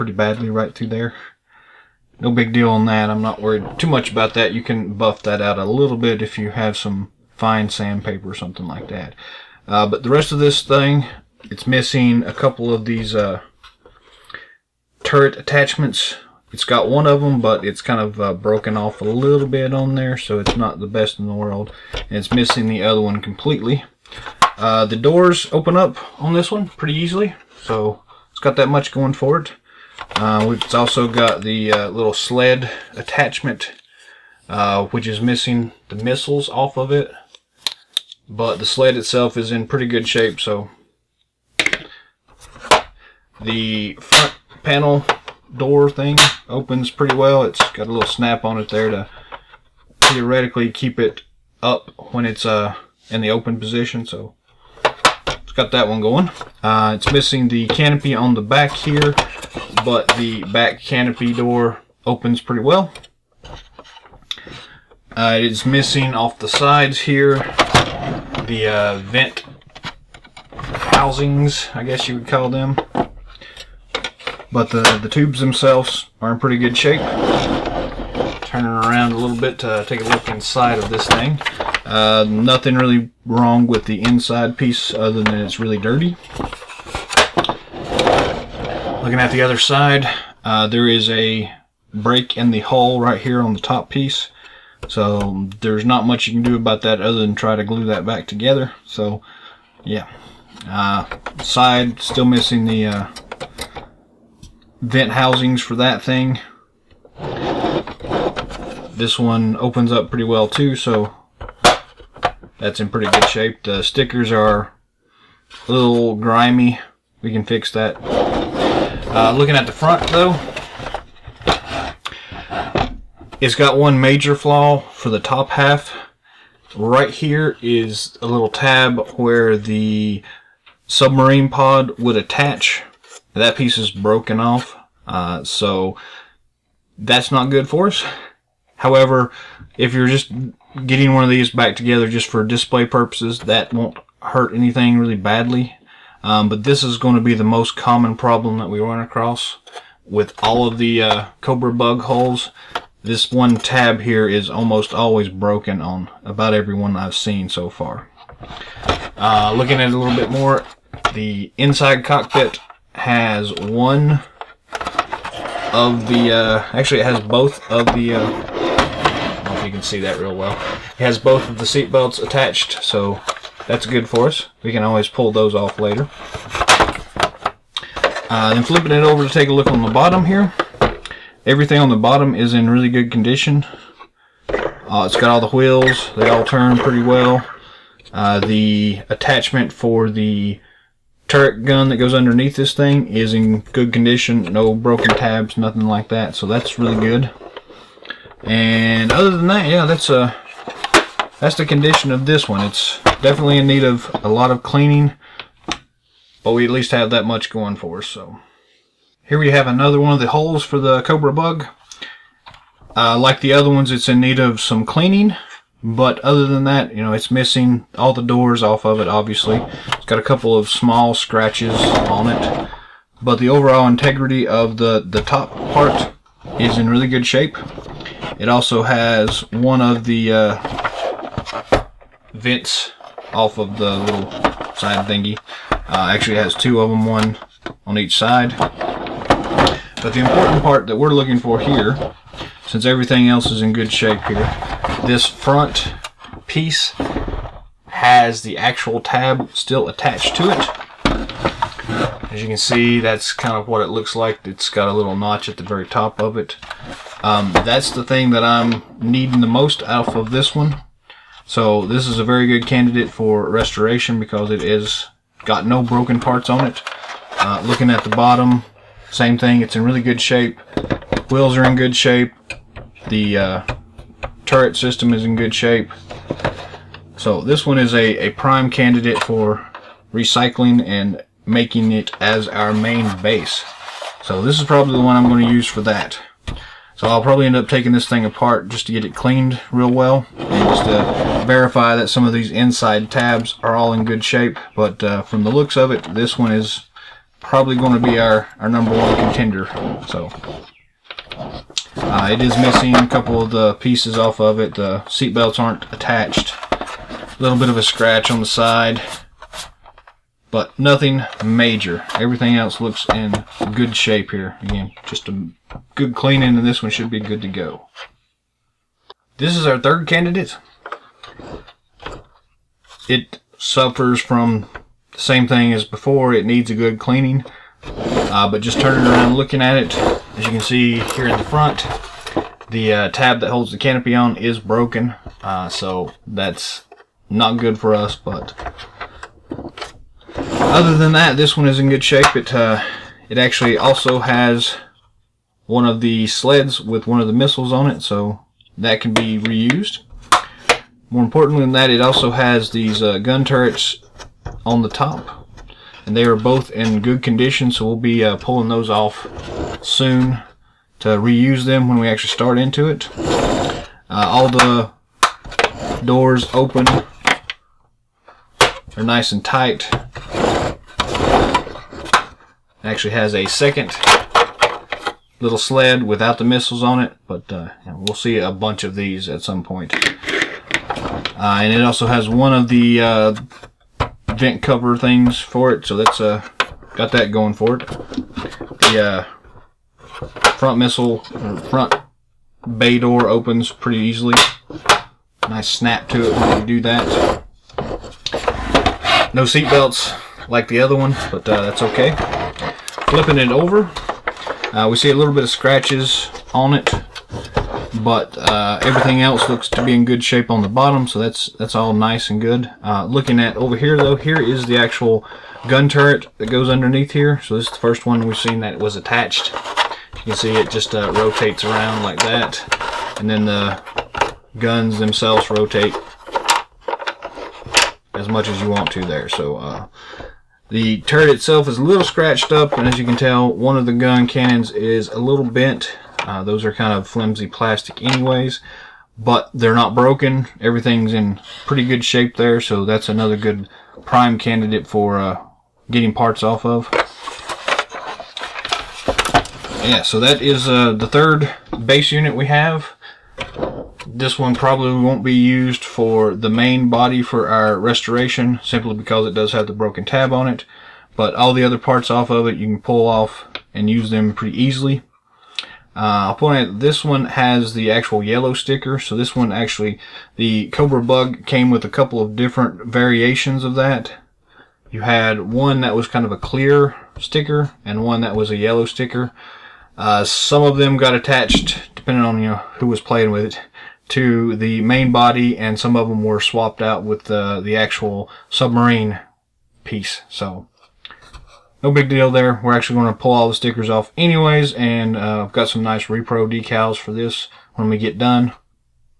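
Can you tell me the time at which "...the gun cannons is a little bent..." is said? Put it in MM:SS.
07:13.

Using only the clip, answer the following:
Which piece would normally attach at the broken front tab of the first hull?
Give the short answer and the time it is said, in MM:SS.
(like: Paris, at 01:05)
Submarine pod, at 02:10.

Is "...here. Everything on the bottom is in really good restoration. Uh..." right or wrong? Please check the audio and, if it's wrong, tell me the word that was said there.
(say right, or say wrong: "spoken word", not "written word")
wrong: "condition", not "restoration".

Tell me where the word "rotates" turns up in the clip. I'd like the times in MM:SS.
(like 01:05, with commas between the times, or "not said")
07:01, 07:05.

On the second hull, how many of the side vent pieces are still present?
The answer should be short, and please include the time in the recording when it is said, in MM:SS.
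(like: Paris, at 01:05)
2, at 03:56.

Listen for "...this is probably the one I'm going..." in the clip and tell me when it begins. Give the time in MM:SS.
04:44.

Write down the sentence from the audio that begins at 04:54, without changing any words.
But uh, from the looks of it, this one is probably going to be our, our number one contender.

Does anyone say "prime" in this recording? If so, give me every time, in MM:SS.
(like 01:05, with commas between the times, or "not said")
04:38, 07:24.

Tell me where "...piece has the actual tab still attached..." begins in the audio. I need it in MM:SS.
04:06.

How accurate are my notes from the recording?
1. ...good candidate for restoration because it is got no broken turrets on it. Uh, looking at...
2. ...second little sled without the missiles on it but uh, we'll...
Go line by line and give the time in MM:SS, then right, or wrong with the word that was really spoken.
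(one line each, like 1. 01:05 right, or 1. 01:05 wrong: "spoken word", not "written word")
1. 04:22 wrong: "parts", not "turrets"
2. 06:13 right.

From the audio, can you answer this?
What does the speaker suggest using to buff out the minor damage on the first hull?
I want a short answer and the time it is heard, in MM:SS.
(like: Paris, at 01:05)
Fine sandpaper, at 00:07.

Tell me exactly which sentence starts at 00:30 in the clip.
Uh, it's also got the uh, little sled attachment, uh, which is missing the missiles off of it.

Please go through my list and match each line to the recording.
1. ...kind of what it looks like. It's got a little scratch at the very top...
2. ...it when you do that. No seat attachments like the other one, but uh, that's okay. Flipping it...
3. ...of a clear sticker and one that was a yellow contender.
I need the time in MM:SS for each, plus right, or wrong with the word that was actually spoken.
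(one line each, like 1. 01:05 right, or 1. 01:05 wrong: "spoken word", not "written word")
1. 04:13 wrong: "notch", not "scratch"
2. 06:36 wrong: "belts", not "attachments"
3. 07:56 wrong: "sticker", not "contender".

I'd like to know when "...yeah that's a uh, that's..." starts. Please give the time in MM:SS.
03:19.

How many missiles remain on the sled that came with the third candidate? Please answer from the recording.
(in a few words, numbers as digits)
1.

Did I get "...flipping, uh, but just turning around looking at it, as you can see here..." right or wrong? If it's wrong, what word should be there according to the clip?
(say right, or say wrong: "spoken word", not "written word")
wrong: "cleaning", not "flipping".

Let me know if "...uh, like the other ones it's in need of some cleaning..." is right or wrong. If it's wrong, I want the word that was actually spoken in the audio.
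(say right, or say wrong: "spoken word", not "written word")
right.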